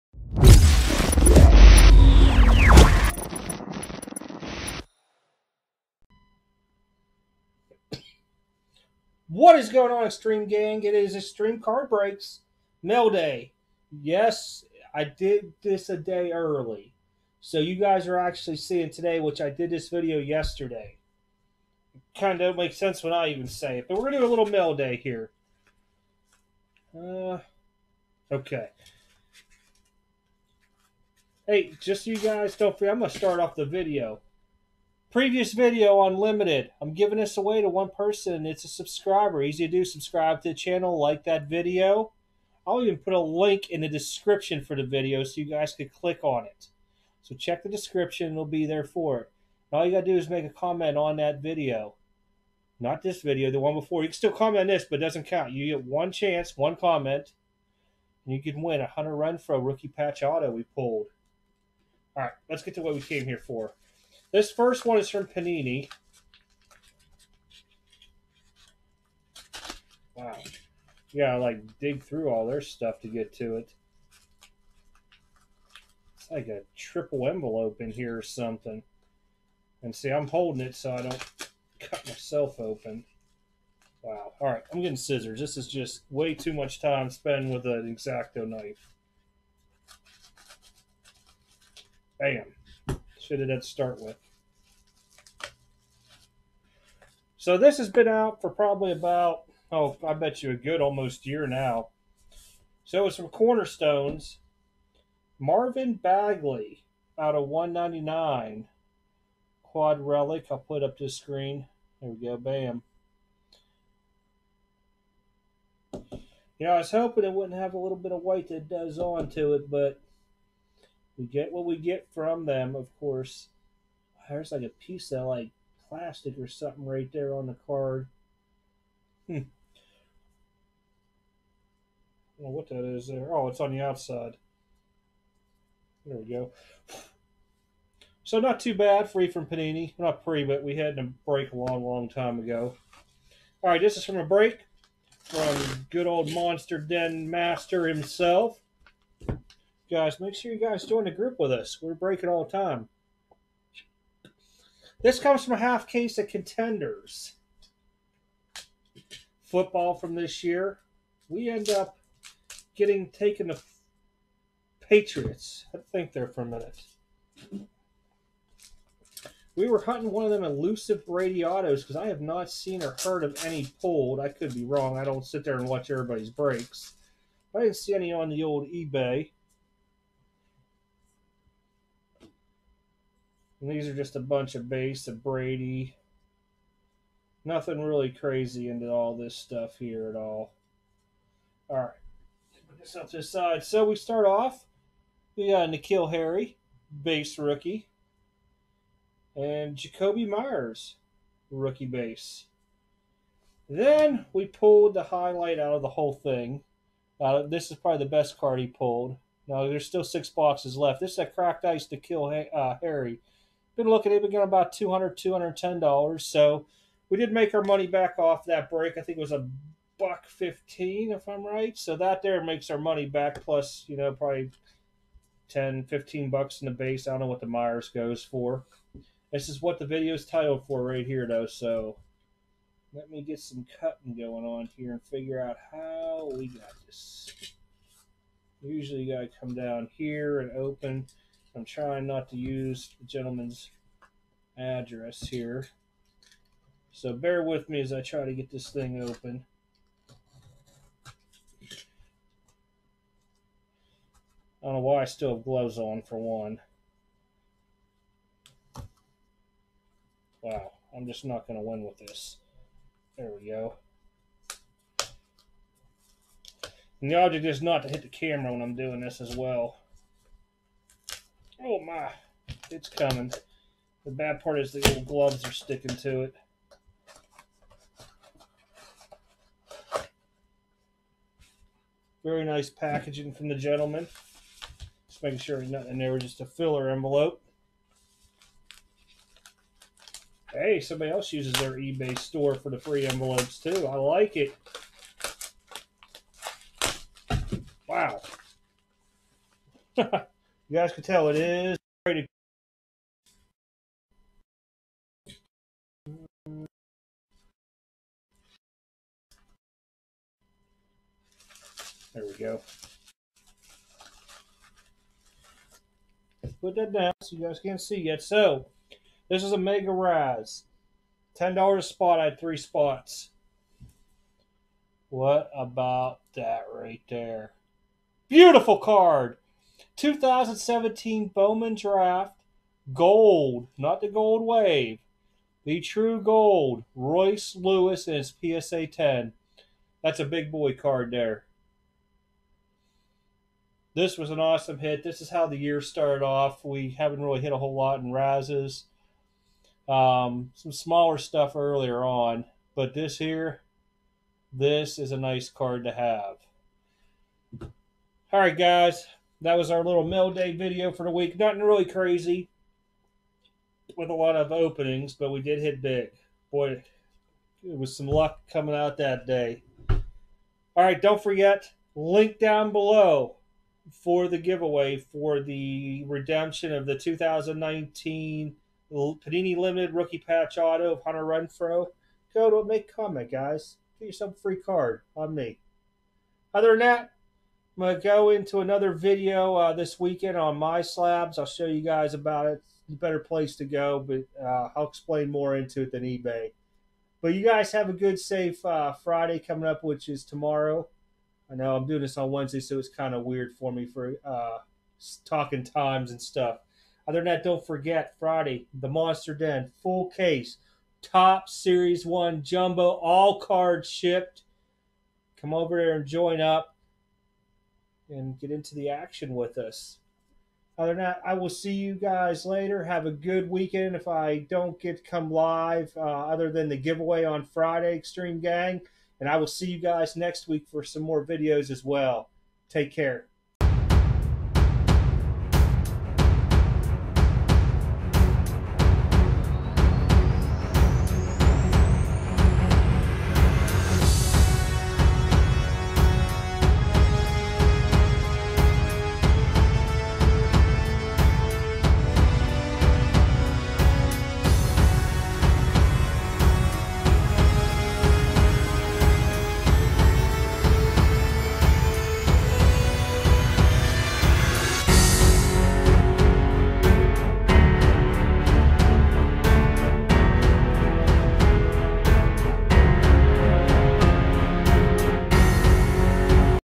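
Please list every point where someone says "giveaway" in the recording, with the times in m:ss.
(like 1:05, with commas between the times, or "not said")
6:14, 7:06.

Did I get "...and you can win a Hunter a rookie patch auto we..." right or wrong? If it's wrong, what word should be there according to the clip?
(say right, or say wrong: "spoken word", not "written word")
right.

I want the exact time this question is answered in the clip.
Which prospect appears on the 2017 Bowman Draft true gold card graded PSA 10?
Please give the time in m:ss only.
5:36.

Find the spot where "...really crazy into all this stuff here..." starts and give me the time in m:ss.
3:07.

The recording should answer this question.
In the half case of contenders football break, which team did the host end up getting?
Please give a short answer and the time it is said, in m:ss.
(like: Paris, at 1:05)
Patriots, at 2:44.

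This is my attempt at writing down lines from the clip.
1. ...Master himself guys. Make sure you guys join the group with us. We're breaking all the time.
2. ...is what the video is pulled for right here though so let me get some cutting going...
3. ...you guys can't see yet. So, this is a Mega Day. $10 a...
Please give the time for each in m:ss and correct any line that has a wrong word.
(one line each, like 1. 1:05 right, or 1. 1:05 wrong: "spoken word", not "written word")
1. 2:27 right
2. 3:49 wrong: "titled", not "pulled"
3. 5:17 wrong: "Rise", not "Day".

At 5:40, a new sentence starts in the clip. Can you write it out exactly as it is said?
That's a big boy card there.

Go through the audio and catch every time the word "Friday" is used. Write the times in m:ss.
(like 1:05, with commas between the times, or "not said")
6:38, 6:48, 7:07.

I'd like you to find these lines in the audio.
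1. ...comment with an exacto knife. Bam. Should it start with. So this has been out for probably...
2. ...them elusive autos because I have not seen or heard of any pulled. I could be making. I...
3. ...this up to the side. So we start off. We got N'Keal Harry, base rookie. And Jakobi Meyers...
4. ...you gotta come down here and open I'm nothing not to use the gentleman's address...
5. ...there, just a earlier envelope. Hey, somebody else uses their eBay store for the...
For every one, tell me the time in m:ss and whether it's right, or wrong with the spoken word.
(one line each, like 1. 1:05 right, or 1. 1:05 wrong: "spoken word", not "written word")
1. 1:27 wrong: "spent", not "comment"
2. 2:50 wrong: "wrong", not "making"
3. 3:12 right
4. 3:59 wrong: "trying", not "nothing"
5. 4:45 wrong: "filler", not "earlier".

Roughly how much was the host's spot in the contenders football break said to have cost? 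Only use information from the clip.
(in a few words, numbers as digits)
$115.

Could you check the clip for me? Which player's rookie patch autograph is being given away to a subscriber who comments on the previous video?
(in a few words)
Hunter Renfrow.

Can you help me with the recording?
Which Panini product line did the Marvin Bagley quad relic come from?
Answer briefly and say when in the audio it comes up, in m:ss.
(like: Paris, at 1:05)
Cornerstones, at 1:43.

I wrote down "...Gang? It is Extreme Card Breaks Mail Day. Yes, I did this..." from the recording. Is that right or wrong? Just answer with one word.
right.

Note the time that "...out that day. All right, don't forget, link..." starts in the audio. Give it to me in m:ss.
6:08.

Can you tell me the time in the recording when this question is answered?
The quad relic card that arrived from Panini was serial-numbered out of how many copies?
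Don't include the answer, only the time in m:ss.
1:47.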